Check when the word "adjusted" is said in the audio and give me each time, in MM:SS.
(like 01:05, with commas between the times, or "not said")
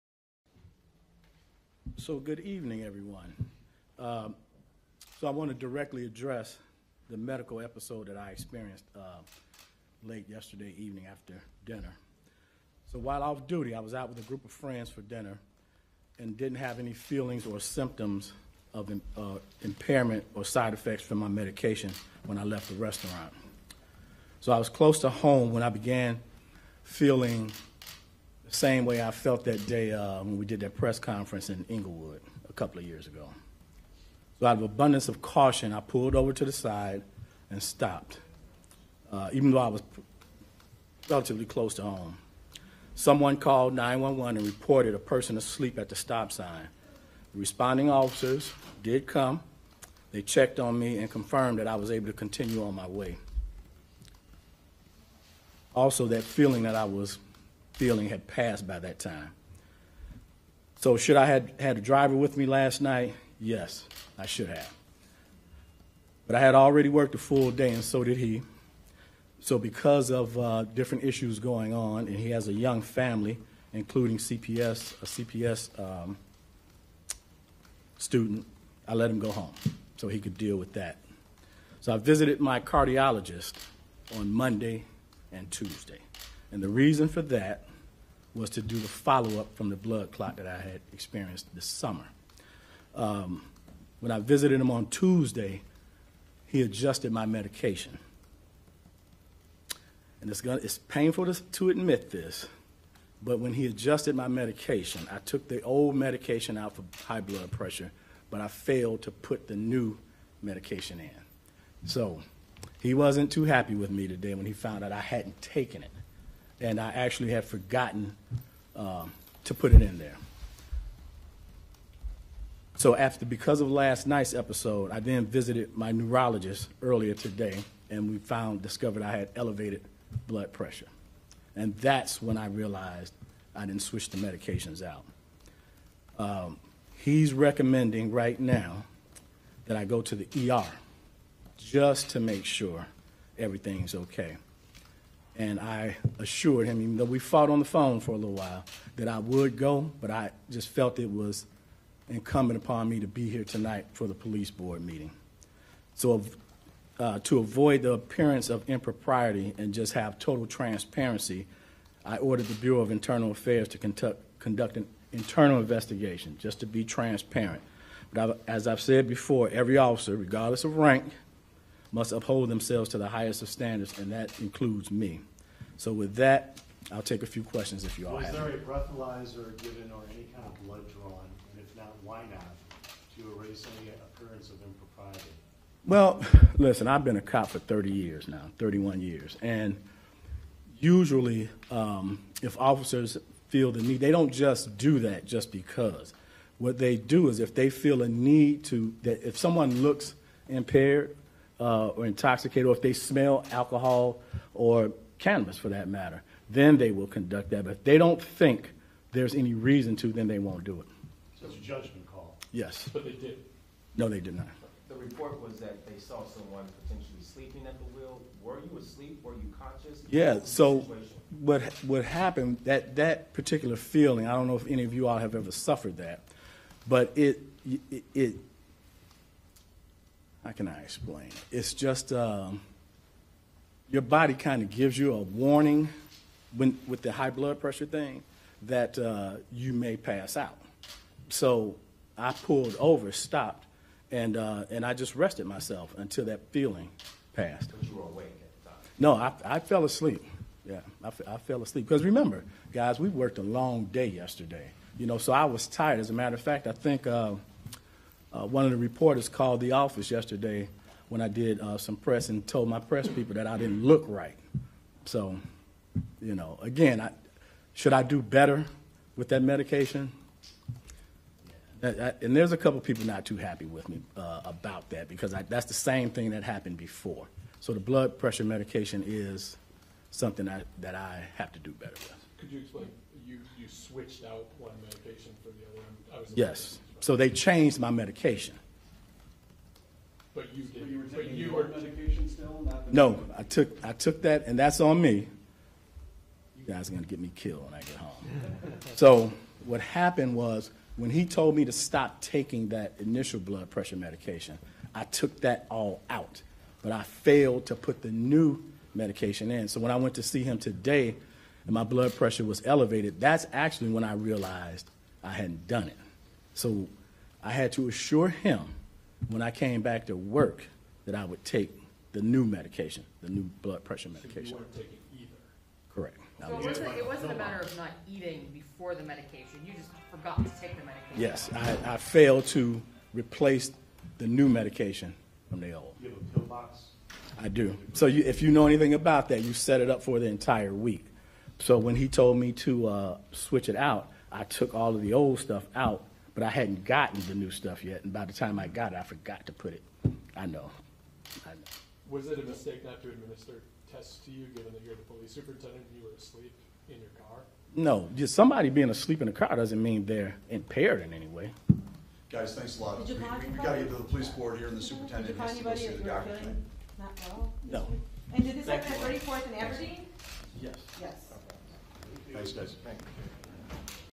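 01:36, 01:43.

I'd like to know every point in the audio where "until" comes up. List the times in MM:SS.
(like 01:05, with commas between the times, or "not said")
04:05.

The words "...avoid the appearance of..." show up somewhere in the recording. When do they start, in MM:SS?
02:37.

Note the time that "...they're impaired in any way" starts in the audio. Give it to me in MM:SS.
06:00.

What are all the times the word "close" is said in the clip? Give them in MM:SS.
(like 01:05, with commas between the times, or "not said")
00:24, 00:41.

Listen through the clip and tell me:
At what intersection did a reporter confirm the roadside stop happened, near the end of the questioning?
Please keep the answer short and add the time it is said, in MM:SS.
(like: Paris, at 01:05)
34th and Aberdeen, at 06:09.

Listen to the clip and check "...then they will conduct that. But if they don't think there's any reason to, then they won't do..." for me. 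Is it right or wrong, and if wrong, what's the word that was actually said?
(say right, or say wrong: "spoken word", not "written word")
right.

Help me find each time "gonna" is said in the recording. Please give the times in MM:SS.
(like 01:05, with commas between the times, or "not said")
01:40, 04:56.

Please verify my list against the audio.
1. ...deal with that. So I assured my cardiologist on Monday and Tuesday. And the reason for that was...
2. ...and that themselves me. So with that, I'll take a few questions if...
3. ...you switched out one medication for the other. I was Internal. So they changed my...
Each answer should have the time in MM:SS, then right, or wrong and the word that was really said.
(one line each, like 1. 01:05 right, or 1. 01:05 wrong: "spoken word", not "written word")
1. 01:20 wrong: "visited", not "assured"
2. 02:53 wrong: "includes", not "themselves"
3. 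04:43 wrong: "Yes", not "Internal".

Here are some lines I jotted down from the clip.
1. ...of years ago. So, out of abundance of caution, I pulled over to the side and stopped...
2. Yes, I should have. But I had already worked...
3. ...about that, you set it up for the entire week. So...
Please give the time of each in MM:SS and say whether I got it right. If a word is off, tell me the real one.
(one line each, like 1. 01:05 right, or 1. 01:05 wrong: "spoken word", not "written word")
1. 00:32 right
2. 01:03 right
3. 05:38 right.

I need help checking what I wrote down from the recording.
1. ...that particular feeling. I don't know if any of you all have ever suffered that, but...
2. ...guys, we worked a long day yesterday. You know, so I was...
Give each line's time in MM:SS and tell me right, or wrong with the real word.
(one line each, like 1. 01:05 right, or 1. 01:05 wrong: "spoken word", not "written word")
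1. 03:42 right
2. 04:12 right.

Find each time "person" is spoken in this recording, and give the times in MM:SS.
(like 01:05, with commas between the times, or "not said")
00:44.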